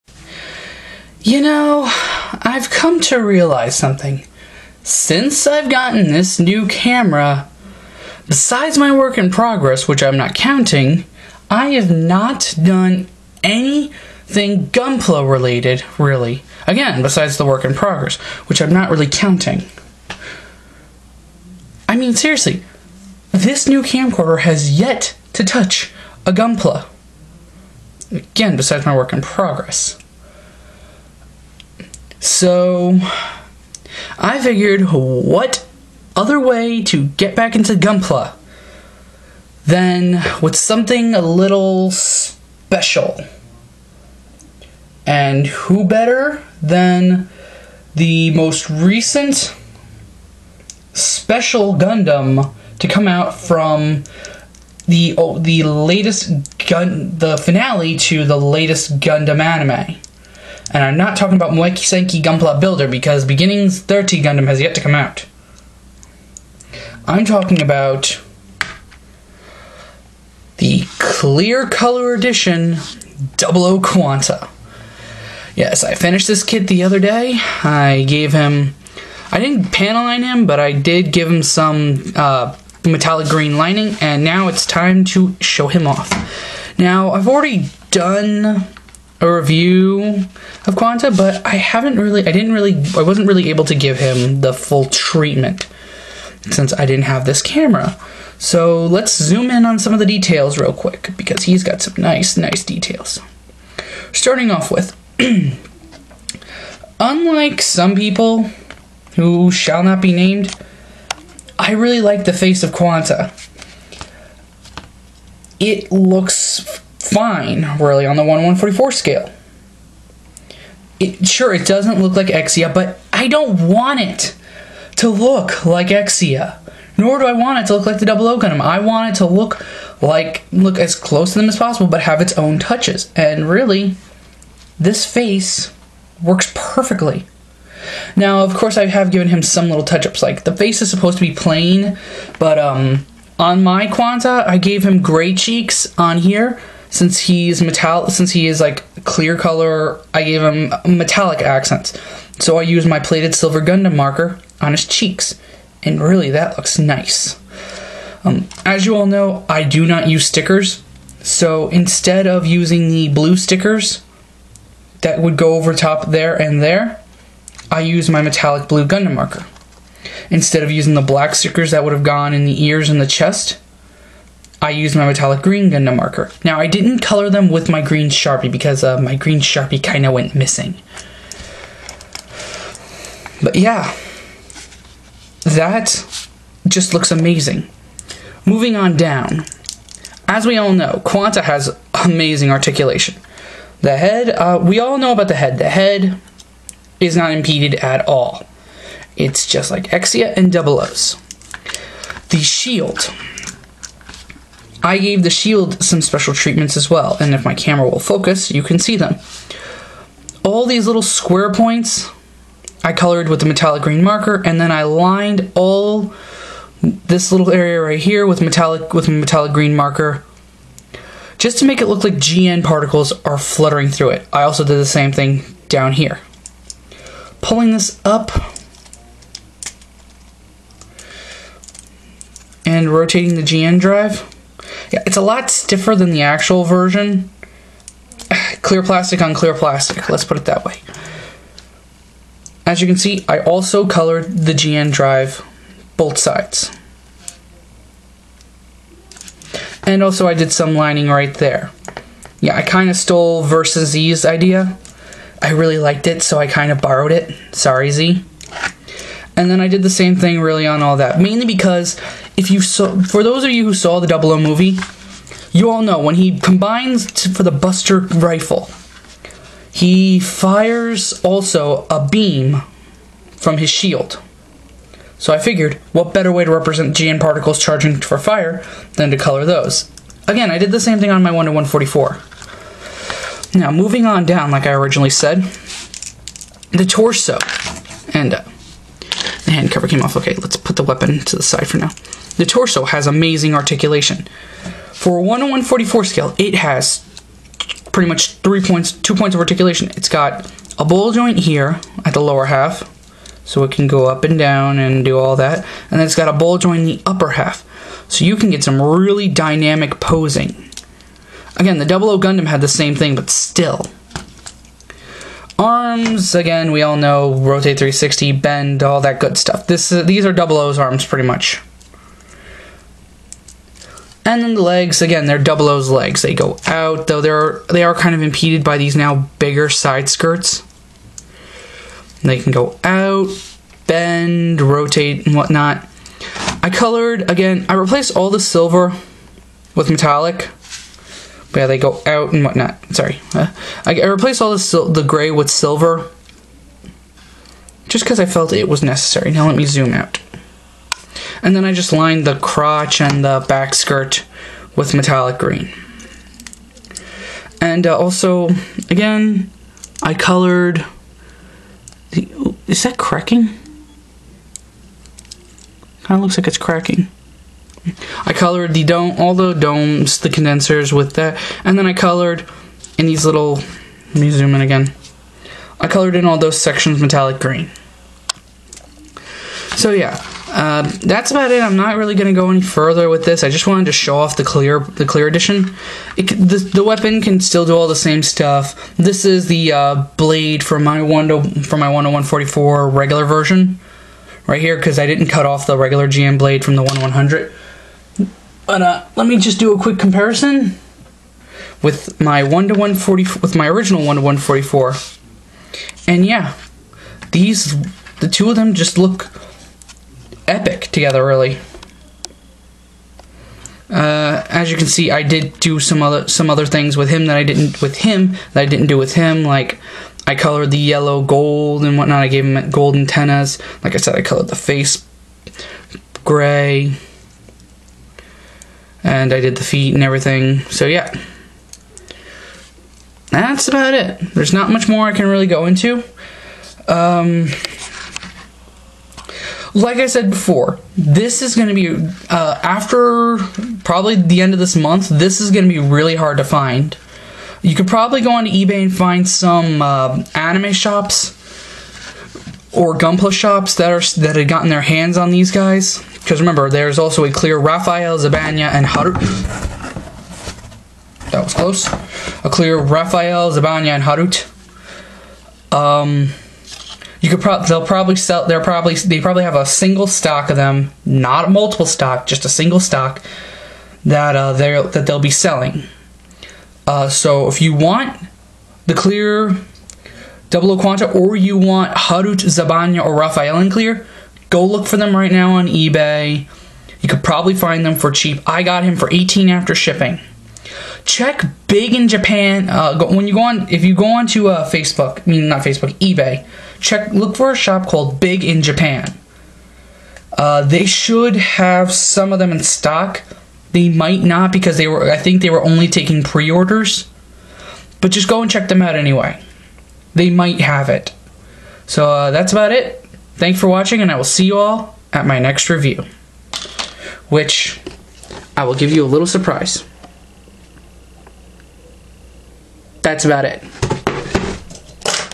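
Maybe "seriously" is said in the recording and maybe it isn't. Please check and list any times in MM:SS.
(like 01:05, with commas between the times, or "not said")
00:22.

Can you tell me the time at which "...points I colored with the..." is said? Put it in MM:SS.
03:31.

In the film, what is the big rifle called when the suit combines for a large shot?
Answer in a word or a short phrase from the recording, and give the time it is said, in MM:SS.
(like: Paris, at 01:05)
Buster rifle, at 04:27.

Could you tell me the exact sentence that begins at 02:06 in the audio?
Nor do I want it to look like the Double O Gundam.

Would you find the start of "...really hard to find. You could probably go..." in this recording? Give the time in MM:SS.
07:25.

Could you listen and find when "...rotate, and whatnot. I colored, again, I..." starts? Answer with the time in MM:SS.
05:34.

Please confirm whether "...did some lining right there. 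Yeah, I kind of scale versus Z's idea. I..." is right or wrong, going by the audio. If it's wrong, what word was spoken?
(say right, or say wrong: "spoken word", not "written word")
wrong: "stole", not "scale".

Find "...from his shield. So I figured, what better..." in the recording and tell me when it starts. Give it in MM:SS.
04:33.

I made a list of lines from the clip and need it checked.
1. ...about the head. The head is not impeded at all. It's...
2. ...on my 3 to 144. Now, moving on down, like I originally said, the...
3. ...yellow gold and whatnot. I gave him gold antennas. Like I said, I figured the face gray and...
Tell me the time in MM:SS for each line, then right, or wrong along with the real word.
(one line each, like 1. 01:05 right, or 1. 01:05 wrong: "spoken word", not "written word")
1. 03:15 right
2. 04:41 wrong: "1", not "3"
3. 07:00 wrong: "colored", not "figured".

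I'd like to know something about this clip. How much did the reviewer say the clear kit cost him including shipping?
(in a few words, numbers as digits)
18.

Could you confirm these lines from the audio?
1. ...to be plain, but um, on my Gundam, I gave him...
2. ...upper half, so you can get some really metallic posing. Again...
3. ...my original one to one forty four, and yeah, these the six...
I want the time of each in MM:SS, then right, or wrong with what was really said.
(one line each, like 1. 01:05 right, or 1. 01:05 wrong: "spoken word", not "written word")
1. 02:21 wrong: "Quanta", not "Gundam"
2. 05:07 wrong: "dynamic", not "metallic"
3. 06:43 wrong: "two", not "six".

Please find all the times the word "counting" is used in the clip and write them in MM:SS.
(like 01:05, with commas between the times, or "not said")
00:10, 00:19.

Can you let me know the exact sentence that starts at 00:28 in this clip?
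Again, besides my work in progress.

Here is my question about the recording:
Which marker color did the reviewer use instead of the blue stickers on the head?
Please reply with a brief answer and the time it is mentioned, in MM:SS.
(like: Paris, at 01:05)
Metallic blue, at 02:48.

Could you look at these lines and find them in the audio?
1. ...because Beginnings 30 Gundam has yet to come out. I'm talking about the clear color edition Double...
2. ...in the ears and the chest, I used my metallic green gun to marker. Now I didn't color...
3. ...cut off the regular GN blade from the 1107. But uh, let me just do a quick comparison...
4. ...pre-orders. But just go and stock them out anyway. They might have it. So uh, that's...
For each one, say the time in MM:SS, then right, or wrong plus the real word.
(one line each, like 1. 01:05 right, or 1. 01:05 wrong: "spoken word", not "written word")
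1. 01:02 right
2. 02:52 right
3. 06:35 wrong: "1100", not "1107"
4. 08:26 wrong: "check", not "stock".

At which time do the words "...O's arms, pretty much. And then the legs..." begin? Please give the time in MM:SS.
05:20.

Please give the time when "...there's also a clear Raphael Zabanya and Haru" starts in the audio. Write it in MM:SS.
07:36.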